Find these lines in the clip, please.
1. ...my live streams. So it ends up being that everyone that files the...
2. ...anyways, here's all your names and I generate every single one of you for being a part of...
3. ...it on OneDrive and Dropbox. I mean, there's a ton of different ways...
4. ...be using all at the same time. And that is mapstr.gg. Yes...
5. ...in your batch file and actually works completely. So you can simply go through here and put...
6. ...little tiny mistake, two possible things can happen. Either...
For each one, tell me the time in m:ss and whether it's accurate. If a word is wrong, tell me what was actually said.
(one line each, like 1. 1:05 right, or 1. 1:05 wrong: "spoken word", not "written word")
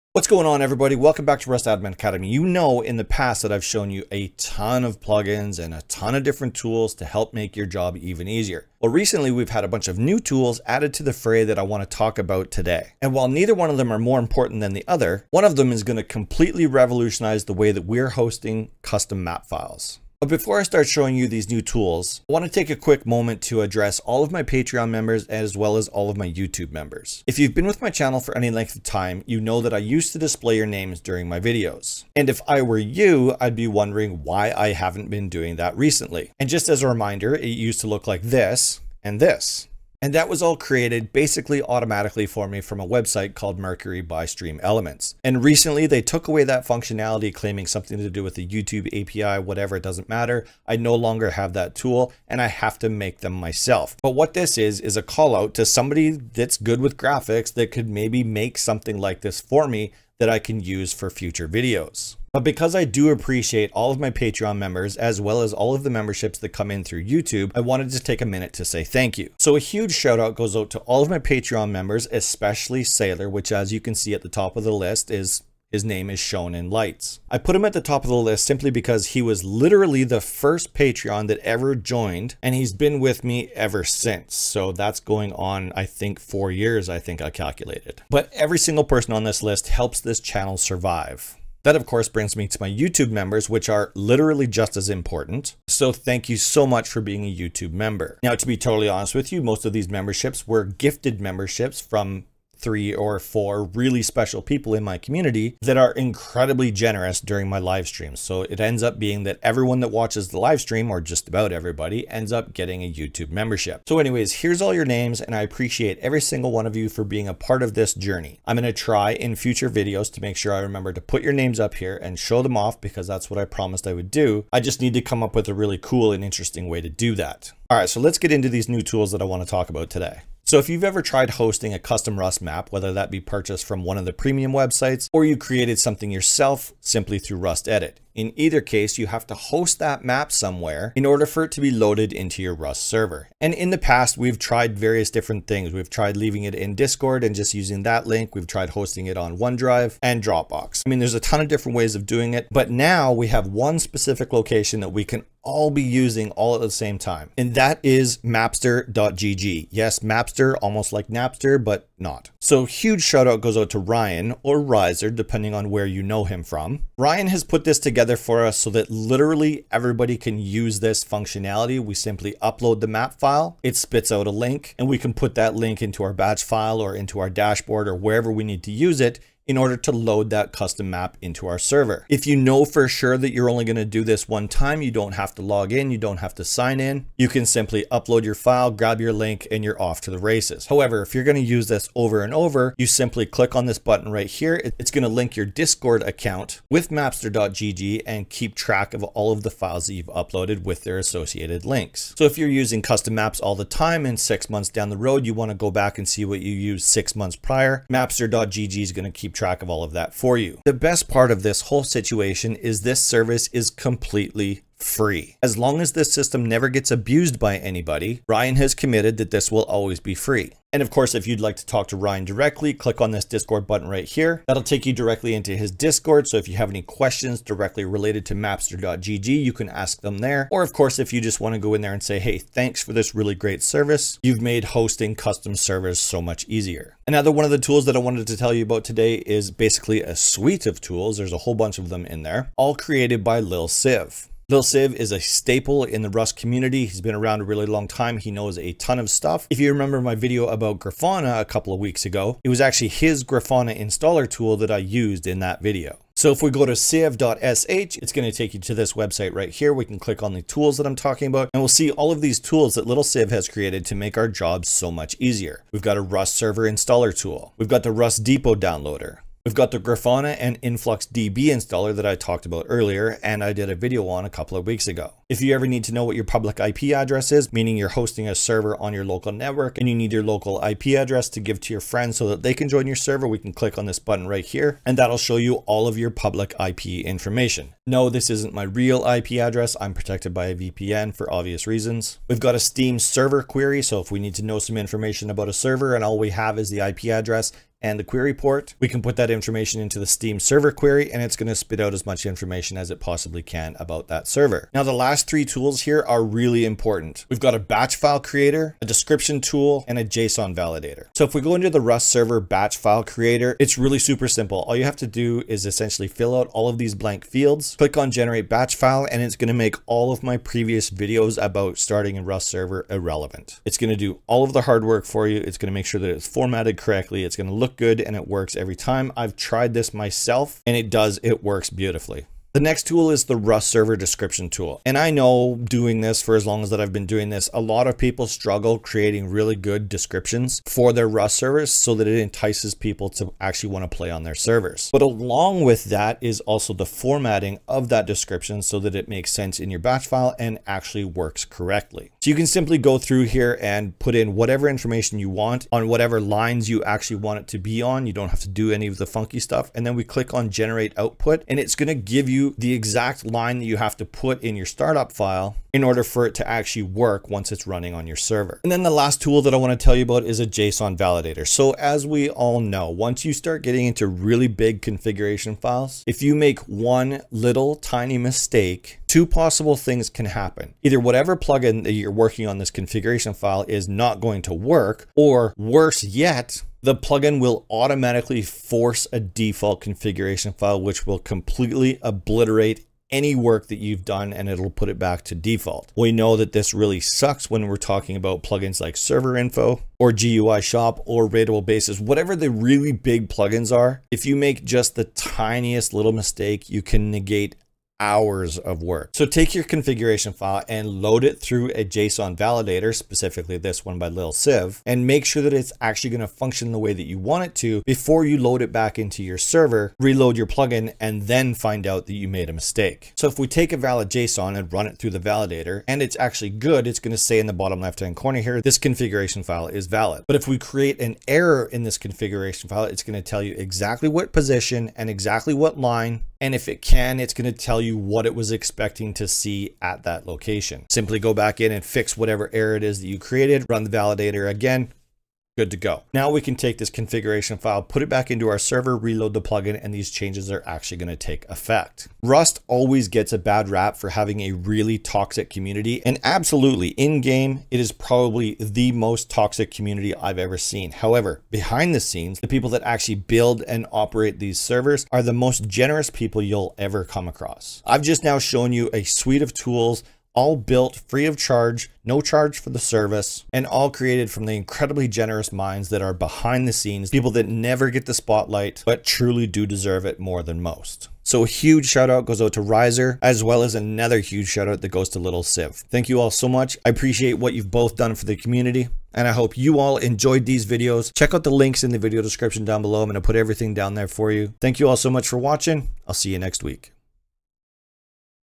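1. 1:47 wrong: "watches", not "files"
2. 1:53 wrong: "appreciate", not "generate"
3. 2:29 right
4. 2:35 right
5. 5:49 wrong: "correctly", not "completely"
6. 6:17 right.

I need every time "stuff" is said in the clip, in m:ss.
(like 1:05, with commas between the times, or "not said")
4:09, 5:59.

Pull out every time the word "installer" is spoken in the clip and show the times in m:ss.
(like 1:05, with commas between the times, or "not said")
4:13, 4:26, 4:31.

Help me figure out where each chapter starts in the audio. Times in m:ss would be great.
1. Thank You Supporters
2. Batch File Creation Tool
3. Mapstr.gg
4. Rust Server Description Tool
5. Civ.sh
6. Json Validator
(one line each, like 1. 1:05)
1. 0:20
2. 5:11
3. 2:08
4. 5:32
5. 3:58
6. 6:10.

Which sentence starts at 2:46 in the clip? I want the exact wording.
Ryan has put this together together for us so that literally everybody can use this functionality.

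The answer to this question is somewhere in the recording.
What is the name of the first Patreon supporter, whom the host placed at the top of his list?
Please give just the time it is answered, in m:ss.
1:12.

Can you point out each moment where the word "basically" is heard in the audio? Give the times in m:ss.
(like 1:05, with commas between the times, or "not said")
0:41, 3:59.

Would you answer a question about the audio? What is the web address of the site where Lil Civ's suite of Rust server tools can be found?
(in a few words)
civ.sh.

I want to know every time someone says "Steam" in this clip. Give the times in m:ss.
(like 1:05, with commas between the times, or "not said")
4:52, 5:00.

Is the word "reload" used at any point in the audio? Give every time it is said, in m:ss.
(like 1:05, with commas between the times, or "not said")
6:59, 7:28.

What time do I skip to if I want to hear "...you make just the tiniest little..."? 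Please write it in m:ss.
6:44.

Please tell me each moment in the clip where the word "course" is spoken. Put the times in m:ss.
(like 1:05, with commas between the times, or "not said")
1:31, 3:40, 3:50.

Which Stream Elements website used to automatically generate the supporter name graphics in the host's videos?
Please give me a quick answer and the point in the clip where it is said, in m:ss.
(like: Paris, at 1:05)
Mercury, at 0:43.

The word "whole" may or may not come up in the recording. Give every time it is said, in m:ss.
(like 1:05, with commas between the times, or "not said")
3:31, 4:01.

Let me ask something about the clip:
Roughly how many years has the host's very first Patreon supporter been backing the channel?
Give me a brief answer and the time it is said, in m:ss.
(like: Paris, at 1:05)
4, at 1:26.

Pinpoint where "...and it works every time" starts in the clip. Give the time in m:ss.
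5:28.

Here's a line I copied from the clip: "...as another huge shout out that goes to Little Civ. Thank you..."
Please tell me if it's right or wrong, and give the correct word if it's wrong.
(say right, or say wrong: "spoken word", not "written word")
right.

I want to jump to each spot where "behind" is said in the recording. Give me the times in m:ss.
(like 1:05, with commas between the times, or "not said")
7:41, 7:56.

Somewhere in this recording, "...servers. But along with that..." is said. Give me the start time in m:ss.
5:44.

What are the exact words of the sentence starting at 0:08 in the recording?
Well, recently we've had a bunch of new tools added to the fray that I want to talk about today.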